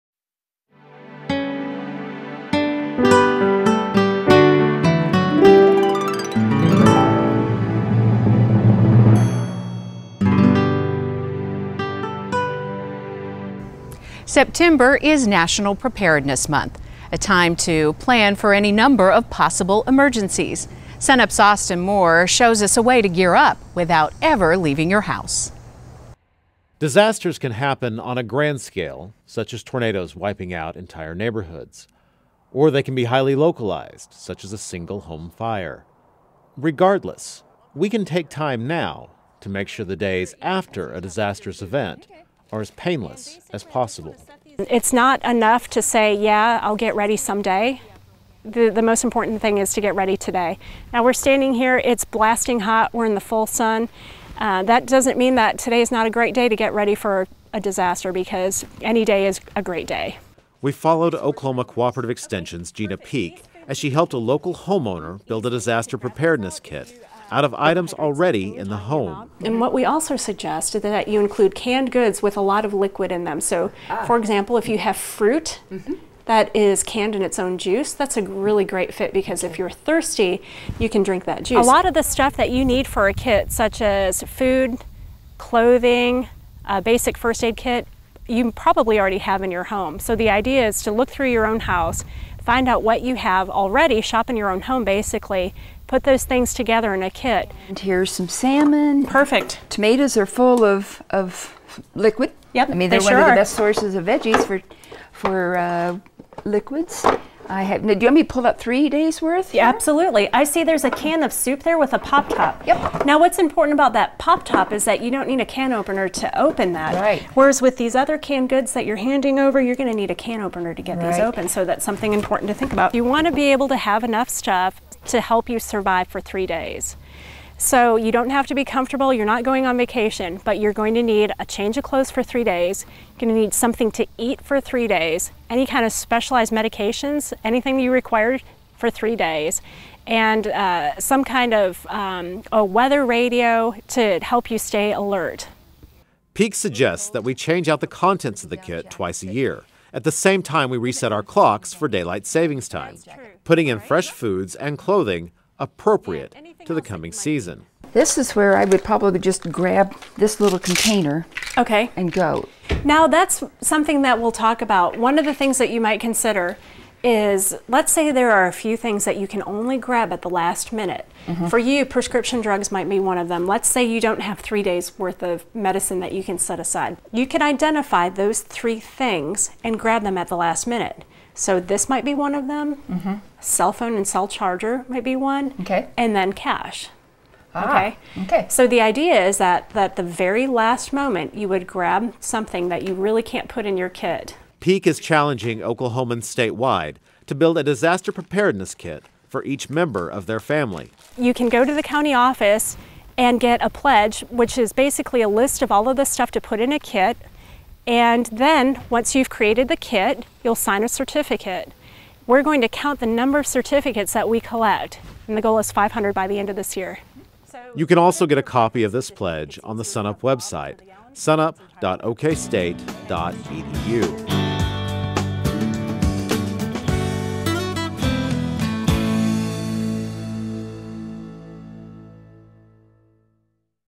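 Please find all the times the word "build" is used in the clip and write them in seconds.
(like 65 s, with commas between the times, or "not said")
65 s, 197 s.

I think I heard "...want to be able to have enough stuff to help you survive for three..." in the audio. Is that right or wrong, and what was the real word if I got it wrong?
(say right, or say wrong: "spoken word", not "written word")
right.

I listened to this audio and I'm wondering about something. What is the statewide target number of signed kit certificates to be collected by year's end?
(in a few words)
500.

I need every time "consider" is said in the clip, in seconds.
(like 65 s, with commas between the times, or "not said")
165 s.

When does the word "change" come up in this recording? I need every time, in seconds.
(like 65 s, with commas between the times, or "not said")
131 s, 147 s.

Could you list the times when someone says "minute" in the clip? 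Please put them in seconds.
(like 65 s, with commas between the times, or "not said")
170 s, 180 s.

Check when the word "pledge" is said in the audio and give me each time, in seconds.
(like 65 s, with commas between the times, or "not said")
203 s, 219 s.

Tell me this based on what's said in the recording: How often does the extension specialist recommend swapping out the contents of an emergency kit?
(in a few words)
Twice a year.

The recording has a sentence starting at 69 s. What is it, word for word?
And what we also suggest is that you include canned goods with a lot of liquid in them.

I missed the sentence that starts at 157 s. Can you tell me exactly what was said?
This is where I would probably just grab this little container okay.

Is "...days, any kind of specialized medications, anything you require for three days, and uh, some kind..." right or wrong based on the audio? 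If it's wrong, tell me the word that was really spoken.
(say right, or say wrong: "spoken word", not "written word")
right.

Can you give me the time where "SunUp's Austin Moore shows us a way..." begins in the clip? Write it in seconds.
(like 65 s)
20 s.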